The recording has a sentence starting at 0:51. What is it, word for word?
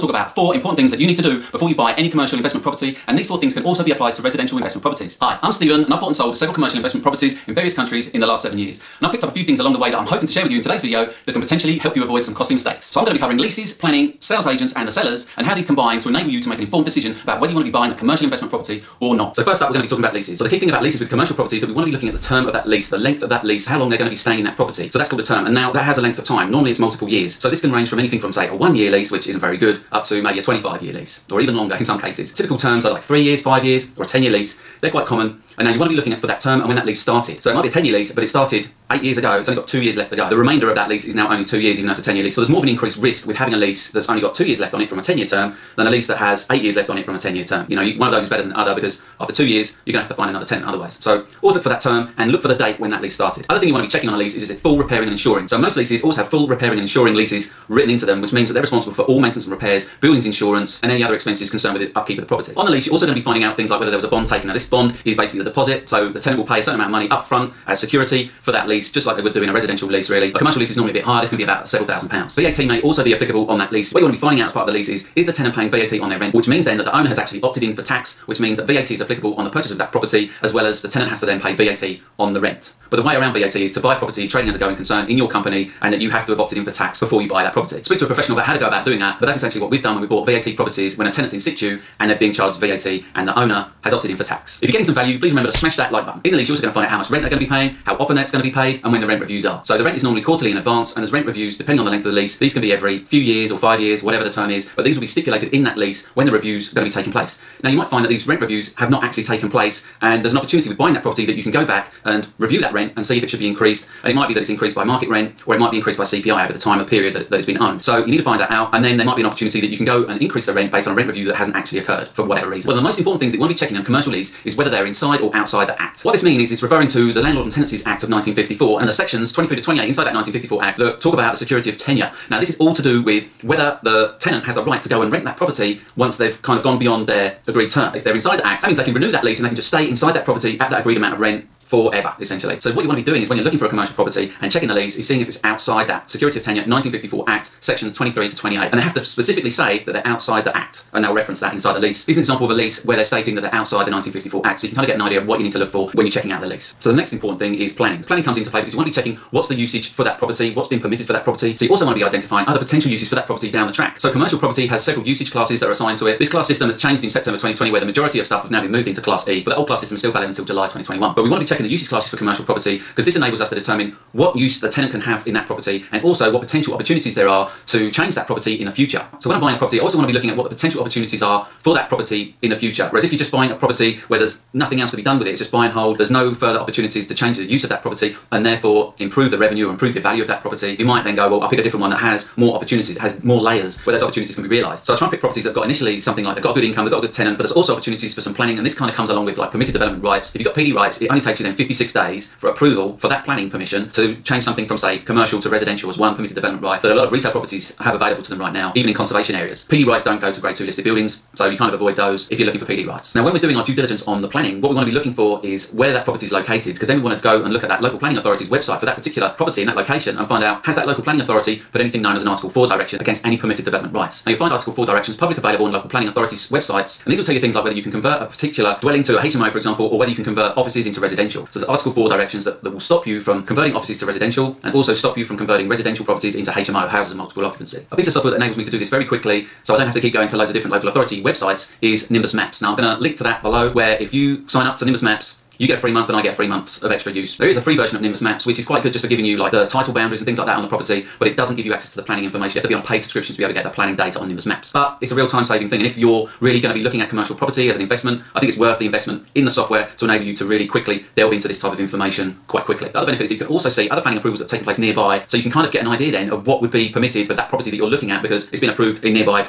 So always look for that term and look for the date when that lease started.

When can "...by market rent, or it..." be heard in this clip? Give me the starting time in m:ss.
1:54.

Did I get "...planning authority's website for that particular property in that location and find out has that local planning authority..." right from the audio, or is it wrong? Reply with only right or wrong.
right.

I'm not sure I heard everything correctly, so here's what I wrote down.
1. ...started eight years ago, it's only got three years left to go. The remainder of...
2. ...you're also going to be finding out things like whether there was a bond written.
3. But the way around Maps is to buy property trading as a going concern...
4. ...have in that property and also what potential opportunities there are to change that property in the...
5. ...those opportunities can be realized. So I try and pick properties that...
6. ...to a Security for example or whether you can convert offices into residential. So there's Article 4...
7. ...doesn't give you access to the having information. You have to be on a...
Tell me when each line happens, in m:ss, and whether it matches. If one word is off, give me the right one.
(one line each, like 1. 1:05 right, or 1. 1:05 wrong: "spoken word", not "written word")
1. 0:38 wrong: "two", not "three"
2. 1:02 wrong: "taken", not "written"
3. 1:22 wrong: "VAT", not "Maps"
4. 2:54 right
5. 3:13 right
6. 3:49 wrong: "HMO", not "Security"
7. 4:11 wrong: "planning", not "having".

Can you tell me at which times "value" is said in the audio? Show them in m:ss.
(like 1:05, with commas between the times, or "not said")
1:34, 3:09.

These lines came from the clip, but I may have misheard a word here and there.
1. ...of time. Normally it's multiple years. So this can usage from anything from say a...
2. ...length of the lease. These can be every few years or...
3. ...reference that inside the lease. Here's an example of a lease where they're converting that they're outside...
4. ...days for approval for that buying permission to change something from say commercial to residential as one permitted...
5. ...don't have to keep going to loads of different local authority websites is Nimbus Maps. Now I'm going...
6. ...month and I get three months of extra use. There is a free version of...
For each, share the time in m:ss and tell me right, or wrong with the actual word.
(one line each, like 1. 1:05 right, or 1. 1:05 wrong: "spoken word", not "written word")
1. 0:26 wrong: "range", not "usage"
2. 1:41 right
3. 2:31 wrong: "stating", not "converting"
4. 3:21 wrong: "planning", not "buying"
5. 3:59 right
6. 4:05 right.